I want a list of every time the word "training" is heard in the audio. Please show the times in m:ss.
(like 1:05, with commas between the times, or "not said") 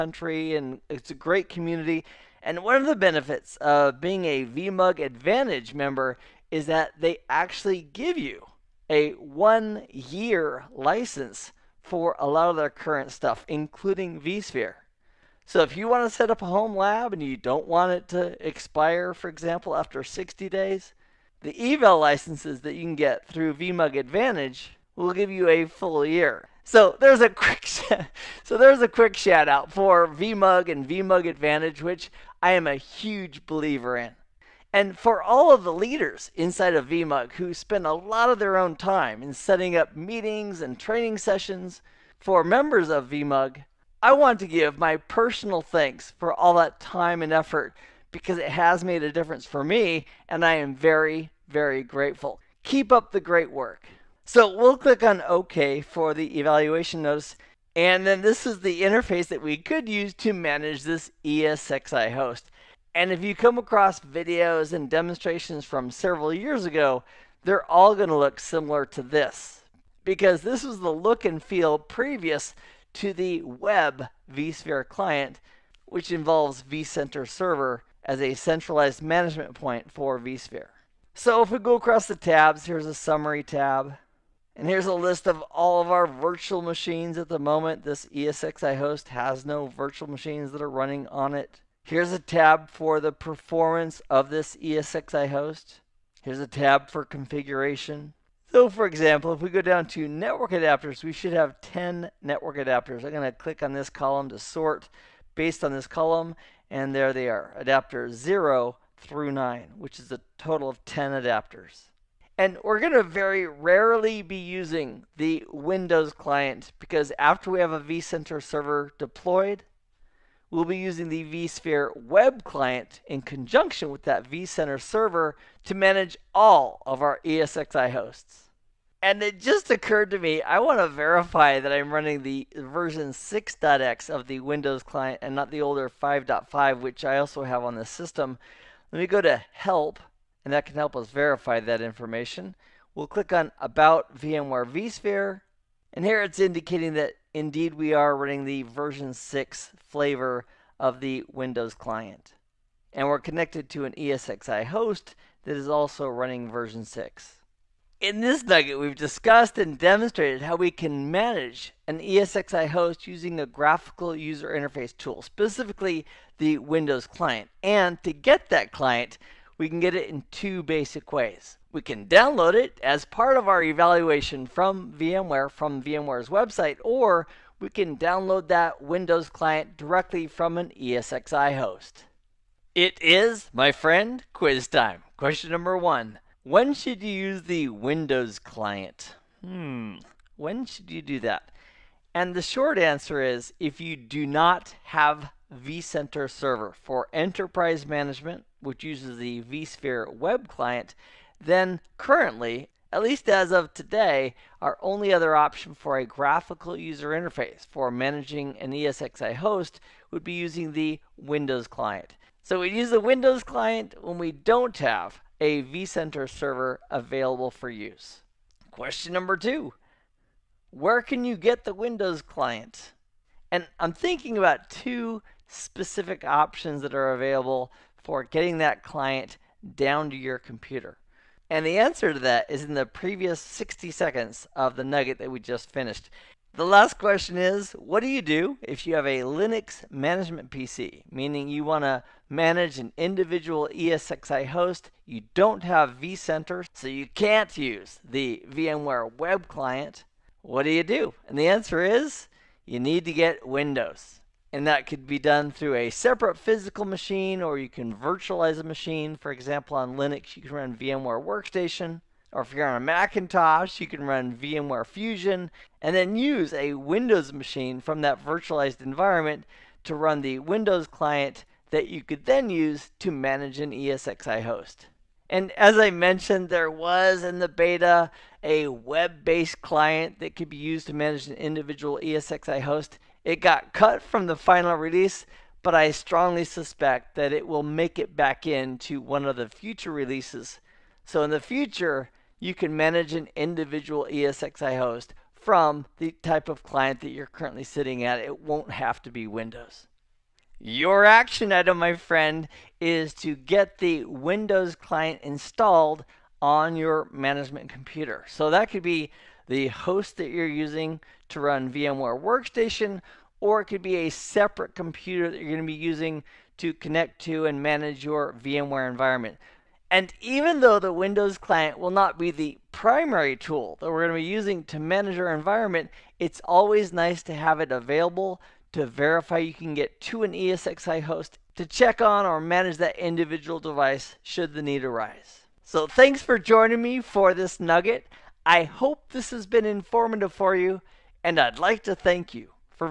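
0:40.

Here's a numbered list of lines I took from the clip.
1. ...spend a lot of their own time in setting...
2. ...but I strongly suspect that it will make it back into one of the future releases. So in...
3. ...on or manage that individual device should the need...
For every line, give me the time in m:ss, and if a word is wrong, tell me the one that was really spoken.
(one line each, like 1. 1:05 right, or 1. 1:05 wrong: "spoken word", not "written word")
1. 0:37 right
2. 4:45 right
3. 5:32 right.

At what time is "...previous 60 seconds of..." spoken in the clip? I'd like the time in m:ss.
3:52.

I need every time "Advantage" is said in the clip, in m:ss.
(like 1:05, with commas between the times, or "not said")
0:05, 0:23, 0:31.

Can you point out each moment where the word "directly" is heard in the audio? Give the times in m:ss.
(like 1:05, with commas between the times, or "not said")
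2:59.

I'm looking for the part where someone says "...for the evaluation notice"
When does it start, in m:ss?
0:55.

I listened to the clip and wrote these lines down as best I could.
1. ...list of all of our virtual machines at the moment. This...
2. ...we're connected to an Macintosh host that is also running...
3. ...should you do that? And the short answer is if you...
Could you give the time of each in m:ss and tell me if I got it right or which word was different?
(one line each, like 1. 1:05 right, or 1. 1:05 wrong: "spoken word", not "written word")
1. 1:24 right
2. 2:33 wrong: "ESXi", not "Macintosh"
3. 3:10 right.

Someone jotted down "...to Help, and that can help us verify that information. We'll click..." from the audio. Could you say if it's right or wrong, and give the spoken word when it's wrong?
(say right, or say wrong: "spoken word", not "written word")
right.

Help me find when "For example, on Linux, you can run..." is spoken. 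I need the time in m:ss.
4:19.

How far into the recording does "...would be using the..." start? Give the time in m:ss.
3:30.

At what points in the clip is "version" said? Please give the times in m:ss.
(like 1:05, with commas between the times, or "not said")
2:12, 2:28, 2:36.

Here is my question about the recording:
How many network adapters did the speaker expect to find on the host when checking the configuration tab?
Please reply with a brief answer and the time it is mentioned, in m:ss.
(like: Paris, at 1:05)
10, at 1:41.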